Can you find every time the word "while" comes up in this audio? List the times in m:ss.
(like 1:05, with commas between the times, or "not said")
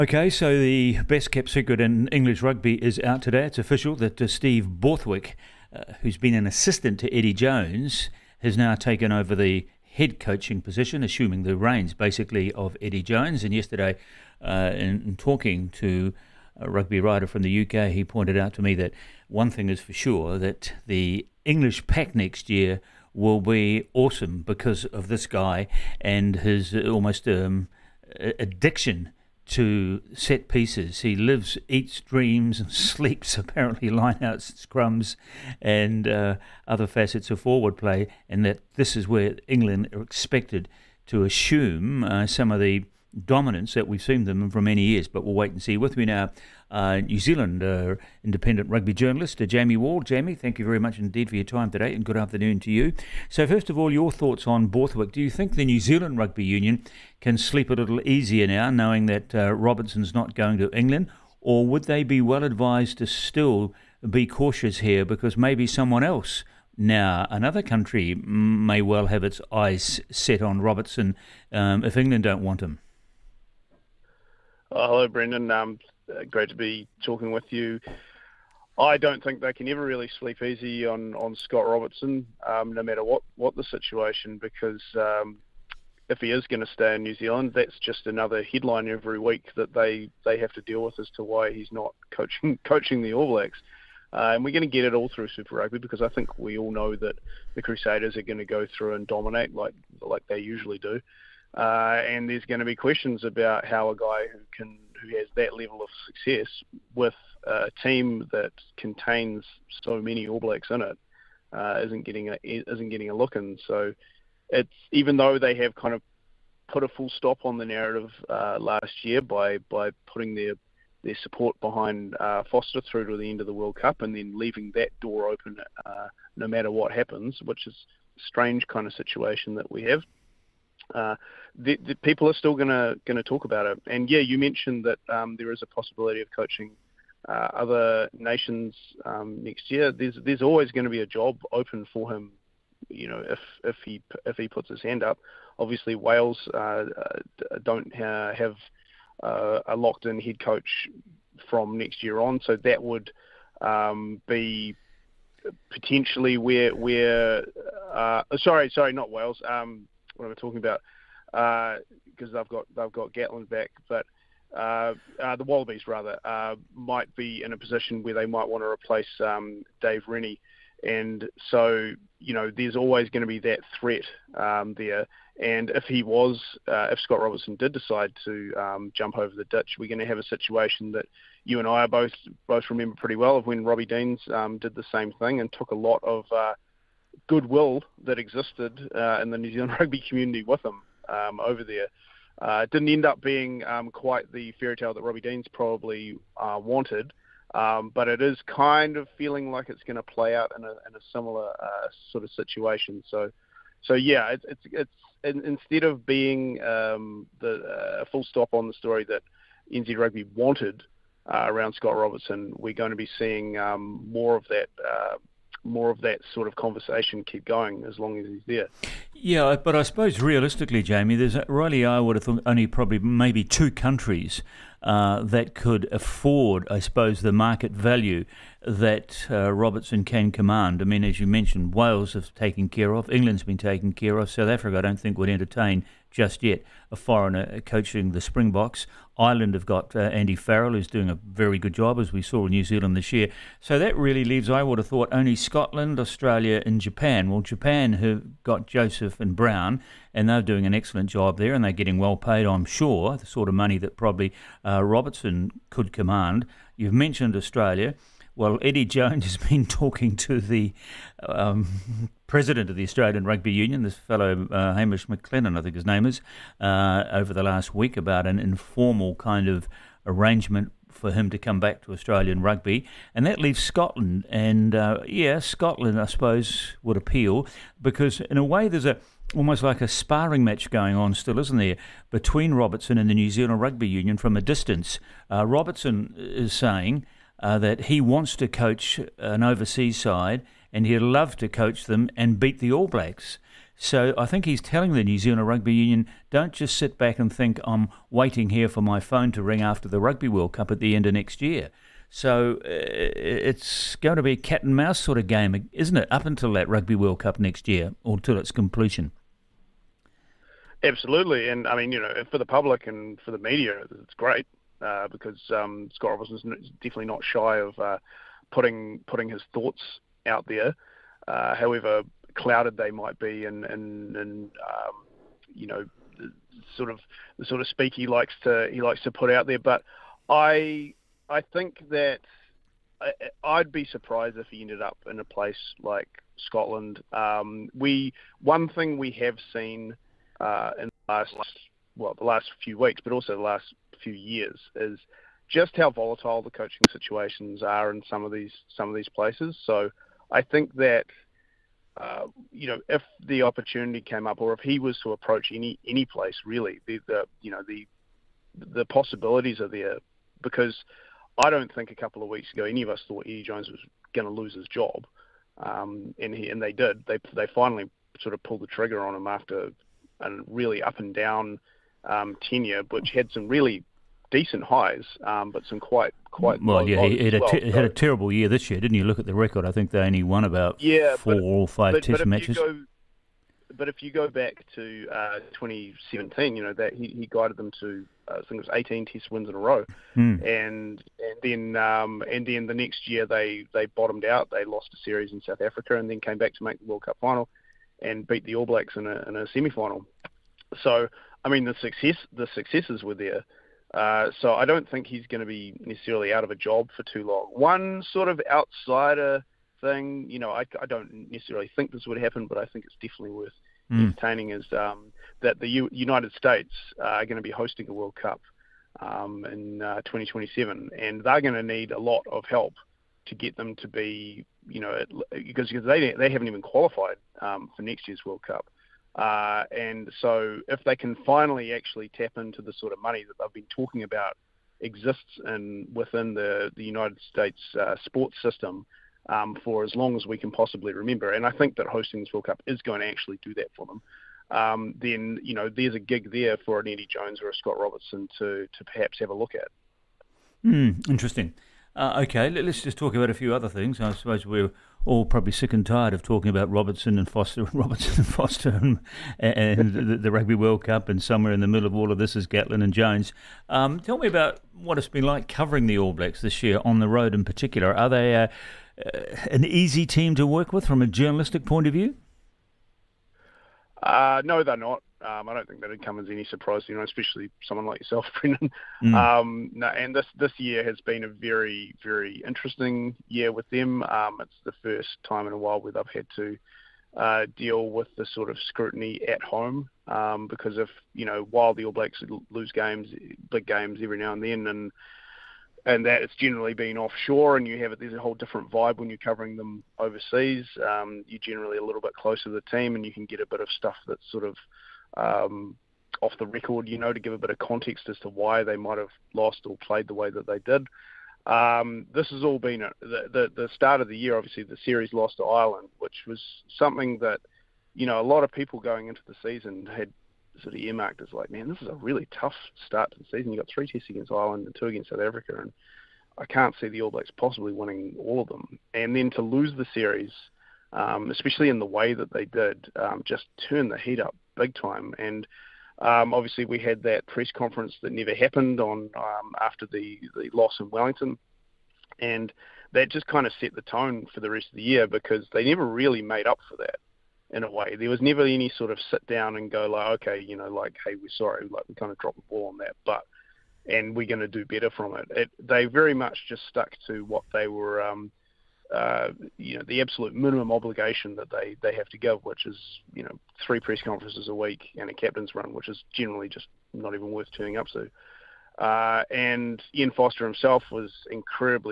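8:05, 8:11.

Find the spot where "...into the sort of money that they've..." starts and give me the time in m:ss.
7:12.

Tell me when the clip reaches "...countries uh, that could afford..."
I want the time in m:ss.
3:43.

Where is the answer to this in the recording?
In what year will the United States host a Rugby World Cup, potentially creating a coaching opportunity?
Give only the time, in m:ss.
7:00.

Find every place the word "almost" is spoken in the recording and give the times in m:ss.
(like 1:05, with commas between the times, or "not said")
0:26, 4:39.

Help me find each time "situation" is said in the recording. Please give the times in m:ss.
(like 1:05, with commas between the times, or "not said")
1:23, 2:08, 3:00, 3:22, 5:46.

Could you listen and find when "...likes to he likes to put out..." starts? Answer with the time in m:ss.
5:28.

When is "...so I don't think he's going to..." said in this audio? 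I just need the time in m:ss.
6:44.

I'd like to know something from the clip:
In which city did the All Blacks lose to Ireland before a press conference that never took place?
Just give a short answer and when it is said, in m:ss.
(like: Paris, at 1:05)
Wellington, at 9:00.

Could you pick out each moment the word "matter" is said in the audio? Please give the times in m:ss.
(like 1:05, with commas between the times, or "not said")
1:22, 2:06.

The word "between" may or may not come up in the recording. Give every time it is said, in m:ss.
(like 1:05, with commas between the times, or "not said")
4:42.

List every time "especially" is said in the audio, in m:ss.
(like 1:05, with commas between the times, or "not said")
7:57, 8:51.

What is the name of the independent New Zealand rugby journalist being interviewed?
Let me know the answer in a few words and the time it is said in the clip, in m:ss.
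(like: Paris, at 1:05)
Jamie Wall, at 0:49.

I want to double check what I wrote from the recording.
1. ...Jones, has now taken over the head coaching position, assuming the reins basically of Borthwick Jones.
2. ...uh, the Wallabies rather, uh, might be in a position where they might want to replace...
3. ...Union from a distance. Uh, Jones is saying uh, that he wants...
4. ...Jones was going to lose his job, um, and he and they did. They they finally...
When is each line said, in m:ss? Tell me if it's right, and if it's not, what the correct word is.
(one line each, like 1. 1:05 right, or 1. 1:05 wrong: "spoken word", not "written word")
1. 0:07 wrong: "Eddie", not "Borthwick"
2. 2:45 right
3. 4:43 wrong: "Robertson", not "Jones"
4. 6:03 right.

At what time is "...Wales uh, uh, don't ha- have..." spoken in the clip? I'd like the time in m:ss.
2:25.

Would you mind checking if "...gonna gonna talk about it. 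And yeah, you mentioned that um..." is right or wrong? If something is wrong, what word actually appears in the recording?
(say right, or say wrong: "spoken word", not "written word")
right.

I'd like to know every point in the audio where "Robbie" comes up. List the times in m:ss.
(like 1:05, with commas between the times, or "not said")
3:03, 3:15.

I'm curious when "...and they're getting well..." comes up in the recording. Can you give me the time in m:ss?
4:11.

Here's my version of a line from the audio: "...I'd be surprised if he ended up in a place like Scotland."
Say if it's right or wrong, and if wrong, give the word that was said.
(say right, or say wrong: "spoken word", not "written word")
right.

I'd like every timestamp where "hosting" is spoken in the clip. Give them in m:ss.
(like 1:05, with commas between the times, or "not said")
6:57, 7:21.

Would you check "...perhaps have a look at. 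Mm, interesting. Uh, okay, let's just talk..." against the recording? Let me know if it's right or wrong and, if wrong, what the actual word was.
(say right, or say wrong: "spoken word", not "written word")
right.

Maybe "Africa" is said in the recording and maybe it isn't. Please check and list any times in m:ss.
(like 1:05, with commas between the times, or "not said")
3:54, 6:35, 8:45.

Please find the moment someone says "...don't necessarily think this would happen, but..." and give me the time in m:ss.
6:50.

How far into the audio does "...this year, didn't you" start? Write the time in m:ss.
6:18.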